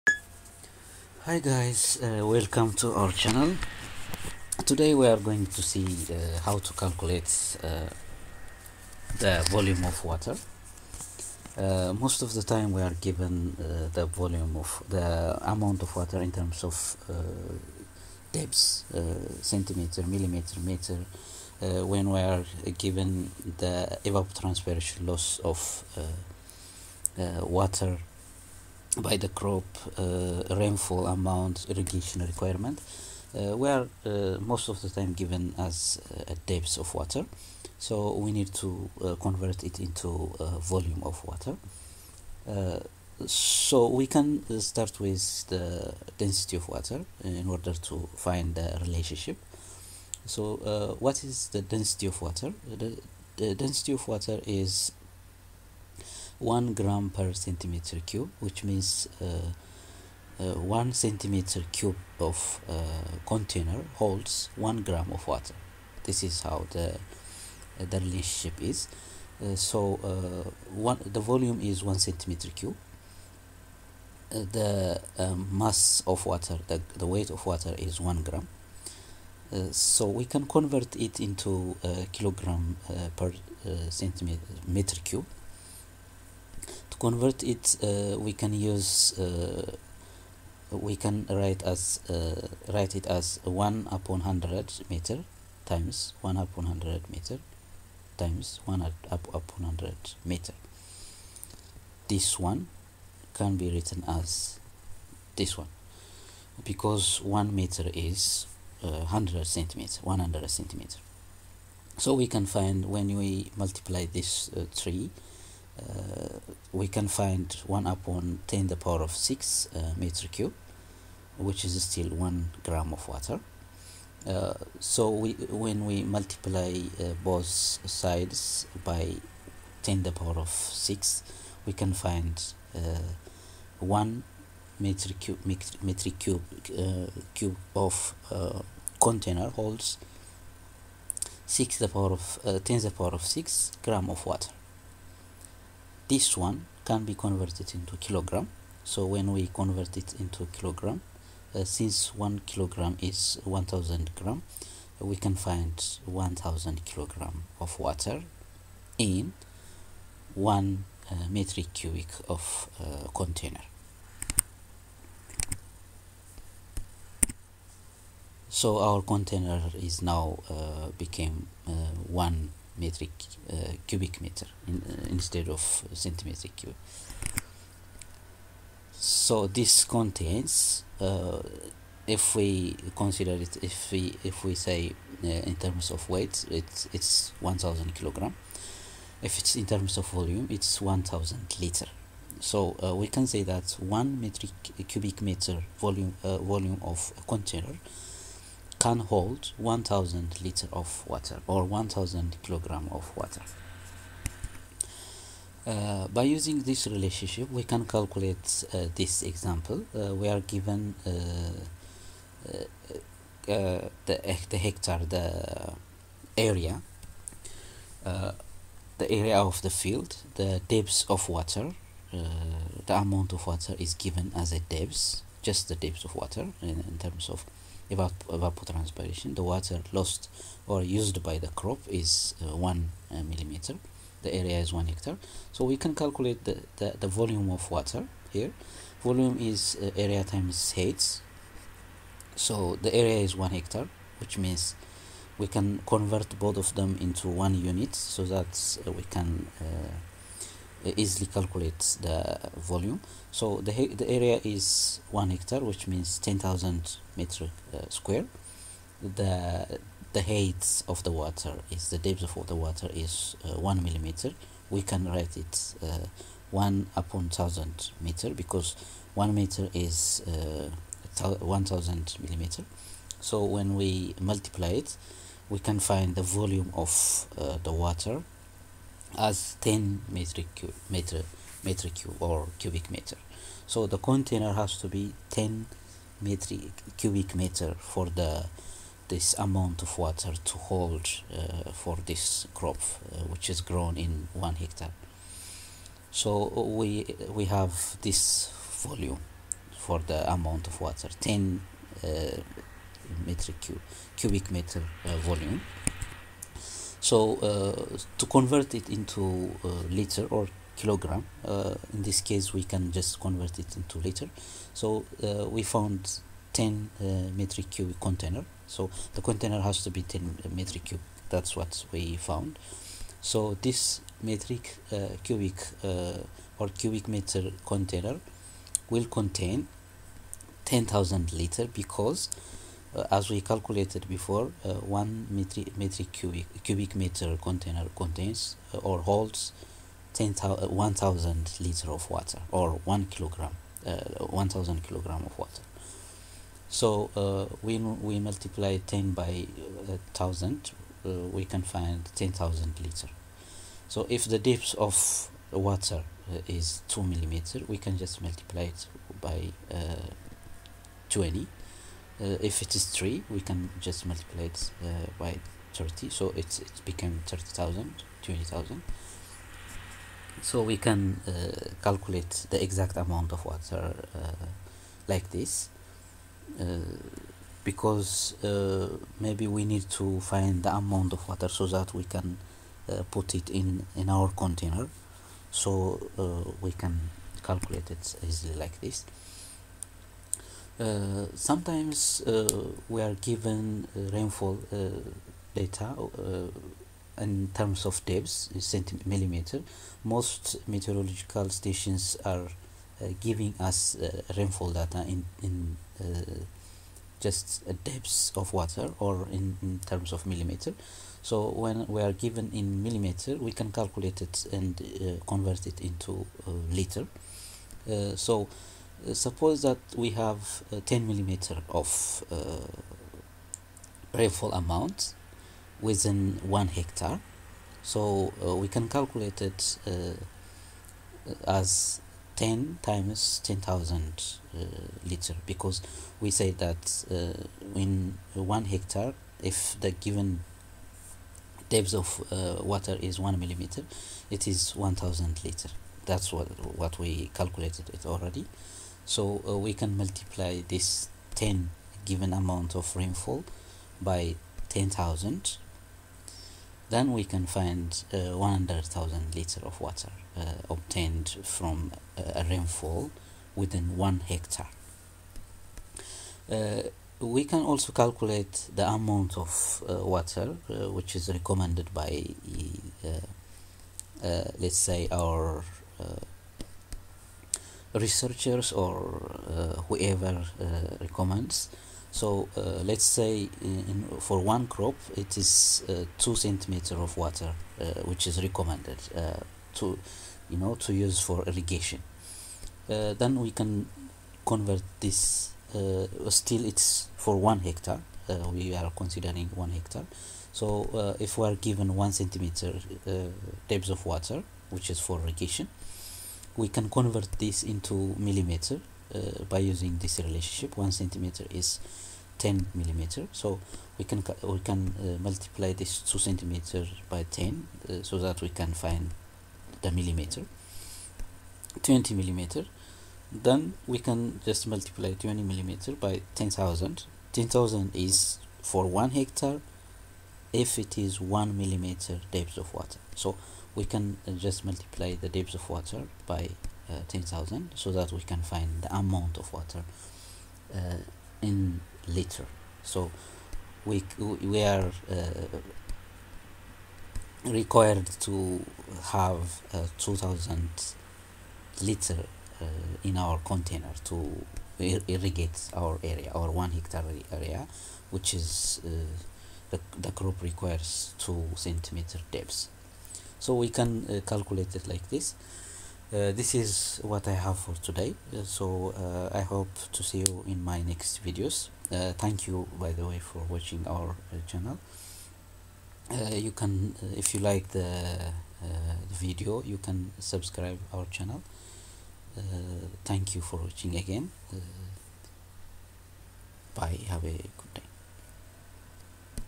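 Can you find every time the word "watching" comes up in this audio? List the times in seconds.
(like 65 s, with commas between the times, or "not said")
573 s, 583 s.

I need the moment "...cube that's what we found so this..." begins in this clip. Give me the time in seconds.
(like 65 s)
320 s.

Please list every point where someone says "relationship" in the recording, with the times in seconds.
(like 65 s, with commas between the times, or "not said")
48 s, 67 s, 206 s, 510 s.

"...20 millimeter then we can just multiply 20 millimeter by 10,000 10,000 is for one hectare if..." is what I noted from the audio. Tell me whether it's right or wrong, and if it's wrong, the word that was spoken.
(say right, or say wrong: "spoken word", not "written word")
right.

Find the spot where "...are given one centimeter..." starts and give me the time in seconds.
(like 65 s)
501 s.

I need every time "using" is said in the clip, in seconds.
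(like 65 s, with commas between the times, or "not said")
206 s, 509 s.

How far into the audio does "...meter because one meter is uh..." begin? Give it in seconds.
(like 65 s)
268 s.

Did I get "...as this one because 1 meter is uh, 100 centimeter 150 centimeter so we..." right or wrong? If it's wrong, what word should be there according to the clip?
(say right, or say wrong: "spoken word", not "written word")
wrong: "100", not "150".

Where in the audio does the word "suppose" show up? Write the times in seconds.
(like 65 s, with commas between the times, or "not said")
419 s.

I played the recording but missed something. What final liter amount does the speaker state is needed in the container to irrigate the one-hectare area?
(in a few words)
2000 liter.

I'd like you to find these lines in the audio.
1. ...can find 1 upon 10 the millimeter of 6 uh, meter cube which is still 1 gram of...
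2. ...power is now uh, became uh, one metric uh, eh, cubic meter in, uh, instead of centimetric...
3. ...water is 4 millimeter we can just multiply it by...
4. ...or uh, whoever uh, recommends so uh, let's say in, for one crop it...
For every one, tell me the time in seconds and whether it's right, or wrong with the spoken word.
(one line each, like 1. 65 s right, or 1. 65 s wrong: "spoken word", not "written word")
1. 116 s wrong: "power", not "millimeter"
2. 169 s wrong: "container", not "power"
3. 355 s wrong: "2", not "4"
4. 478 s right.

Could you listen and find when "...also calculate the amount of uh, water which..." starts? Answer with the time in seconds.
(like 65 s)
467 s.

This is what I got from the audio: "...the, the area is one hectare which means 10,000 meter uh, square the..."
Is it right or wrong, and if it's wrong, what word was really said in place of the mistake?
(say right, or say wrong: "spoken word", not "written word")
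right.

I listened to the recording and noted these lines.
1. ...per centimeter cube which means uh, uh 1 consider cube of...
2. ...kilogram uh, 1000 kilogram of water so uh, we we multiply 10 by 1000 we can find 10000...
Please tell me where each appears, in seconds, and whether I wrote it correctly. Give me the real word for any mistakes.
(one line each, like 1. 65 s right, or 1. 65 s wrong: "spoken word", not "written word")
1. 57 s wrong: "centimeter", not "consider"
2. 343 s right.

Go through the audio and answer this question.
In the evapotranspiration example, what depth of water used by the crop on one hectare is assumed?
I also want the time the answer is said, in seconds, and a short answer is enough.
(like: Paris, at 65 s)
1 millimeter, at 232 s.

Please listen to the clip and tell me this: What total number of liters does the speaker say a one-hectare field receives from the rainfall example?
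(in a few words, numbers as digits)
100,000 liter.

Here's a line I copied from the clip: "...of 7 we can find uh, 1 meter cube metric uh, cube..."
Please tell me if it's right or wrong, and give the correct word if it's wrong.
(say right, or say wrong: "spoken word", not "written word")
wrong: "6", not "7".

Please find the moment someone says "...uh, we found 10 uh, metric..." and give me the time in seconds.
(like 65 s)
315 s.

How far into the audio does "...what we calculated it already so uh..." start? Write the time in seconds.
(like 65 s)
446 s.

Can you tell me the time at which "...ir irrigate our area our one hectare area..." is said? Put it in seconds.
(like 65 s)
554 s.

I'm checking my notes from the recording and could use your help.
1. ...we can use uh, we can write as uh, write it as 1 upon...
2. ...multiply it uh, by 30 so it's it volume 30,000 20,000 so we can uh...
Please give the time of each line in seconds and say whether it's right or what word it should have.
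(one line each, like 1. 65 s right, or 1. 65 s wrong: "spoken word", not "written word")
1. 88 s right
2. 364 s wrong: "became", not "volume".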